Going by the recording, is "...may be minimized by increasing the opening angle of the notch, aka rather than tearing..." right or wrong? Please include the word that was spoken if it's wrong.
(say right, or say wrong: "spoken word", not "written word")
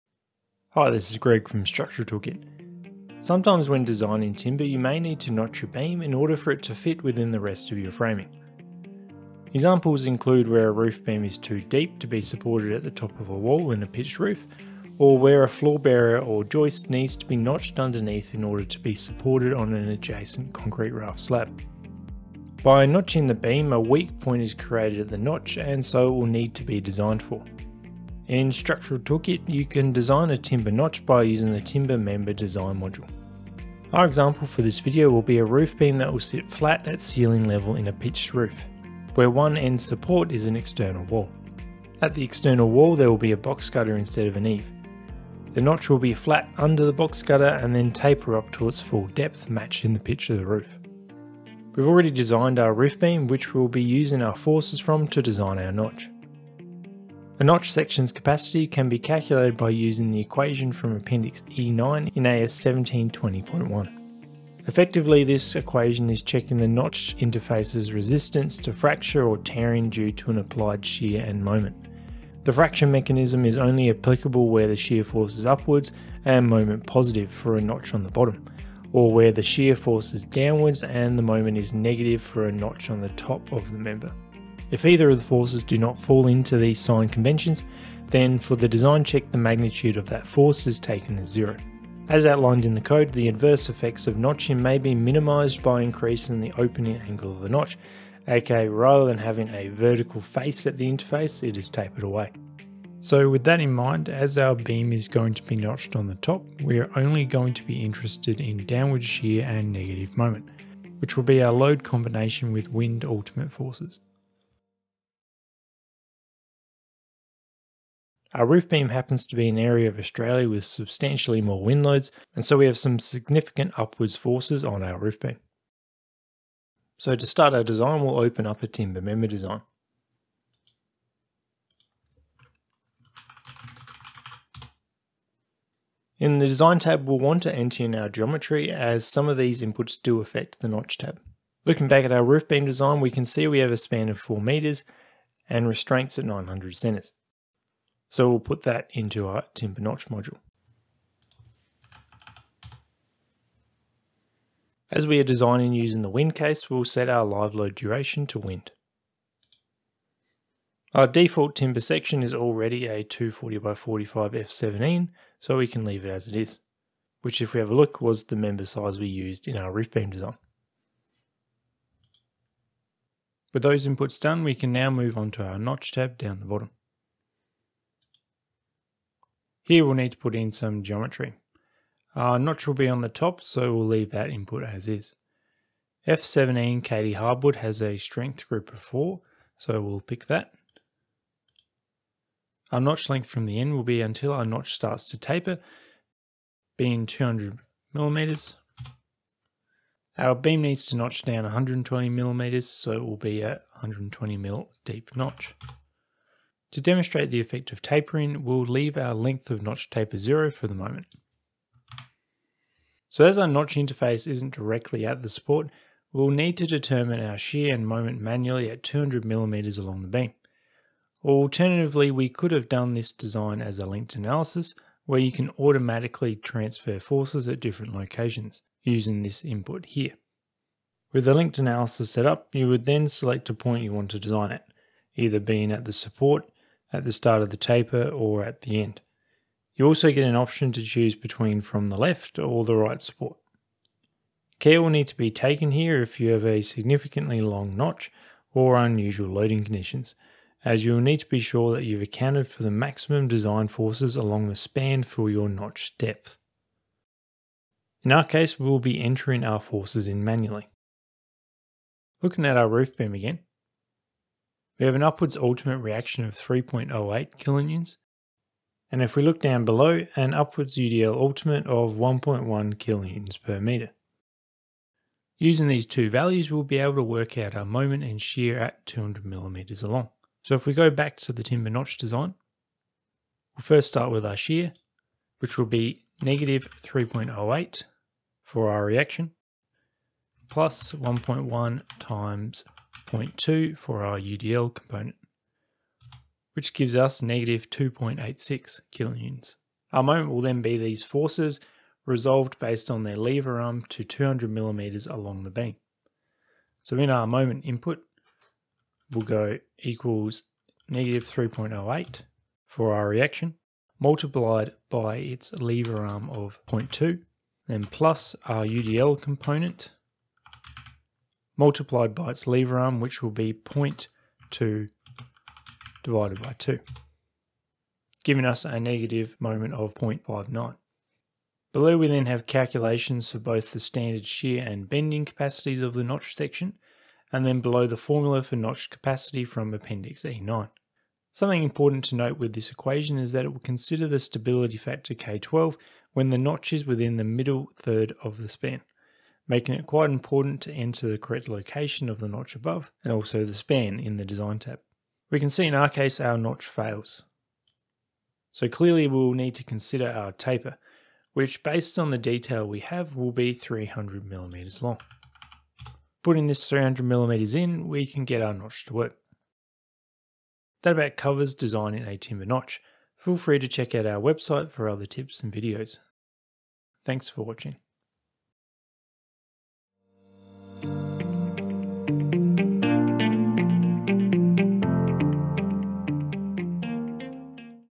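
wrong: "having", not "tearing".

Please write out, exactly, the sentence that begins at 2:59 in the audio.
Here we'll need to put in some geometry.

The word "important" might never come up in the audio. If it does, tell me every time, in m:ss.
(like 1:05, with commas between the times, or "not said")
5:41, 5:50.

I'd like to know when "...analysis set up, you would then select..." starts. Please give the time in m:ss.
3:51.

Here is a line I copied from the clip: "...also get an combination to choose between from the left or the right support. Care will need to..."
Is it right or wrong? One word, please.
wrong.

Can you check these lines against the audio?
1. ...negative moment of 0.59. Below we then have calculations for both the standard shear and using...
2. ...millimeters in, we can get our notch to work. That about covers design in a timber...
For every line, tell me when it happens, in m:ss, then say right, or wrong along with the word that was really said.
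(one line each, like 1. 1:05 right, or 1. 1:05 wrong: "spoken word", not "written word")
1. 5:28 wrong: "bending", not "using"
2. 6:07 right.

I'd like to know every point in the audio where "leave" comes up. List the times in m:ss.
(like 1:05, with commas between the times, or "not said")
2:45, 3:03, 3:28.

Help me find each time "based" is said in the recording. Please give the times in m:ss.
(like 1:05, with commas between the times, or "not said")
5:02, 6:01.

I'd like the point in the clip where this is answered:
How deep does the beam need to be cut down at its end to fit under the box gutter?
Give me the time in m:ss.
3:23.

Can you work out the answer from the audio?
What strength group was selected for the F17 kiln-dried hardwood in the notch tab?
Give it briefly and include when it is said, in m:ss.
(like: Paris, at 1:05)
4, at 3:07.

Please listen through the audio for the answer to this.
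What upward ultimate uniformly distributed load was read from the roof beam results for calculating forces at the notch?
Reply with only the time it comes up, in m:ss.
4:31.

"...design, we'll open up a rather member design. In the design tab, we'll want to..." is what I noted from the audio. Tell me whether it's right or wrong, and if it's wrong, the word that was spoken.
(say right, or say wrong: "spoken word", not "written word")
wrong: "timber", not "rather".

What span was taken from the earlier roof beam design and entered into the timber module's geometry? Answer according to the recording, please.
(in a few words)
4 meters.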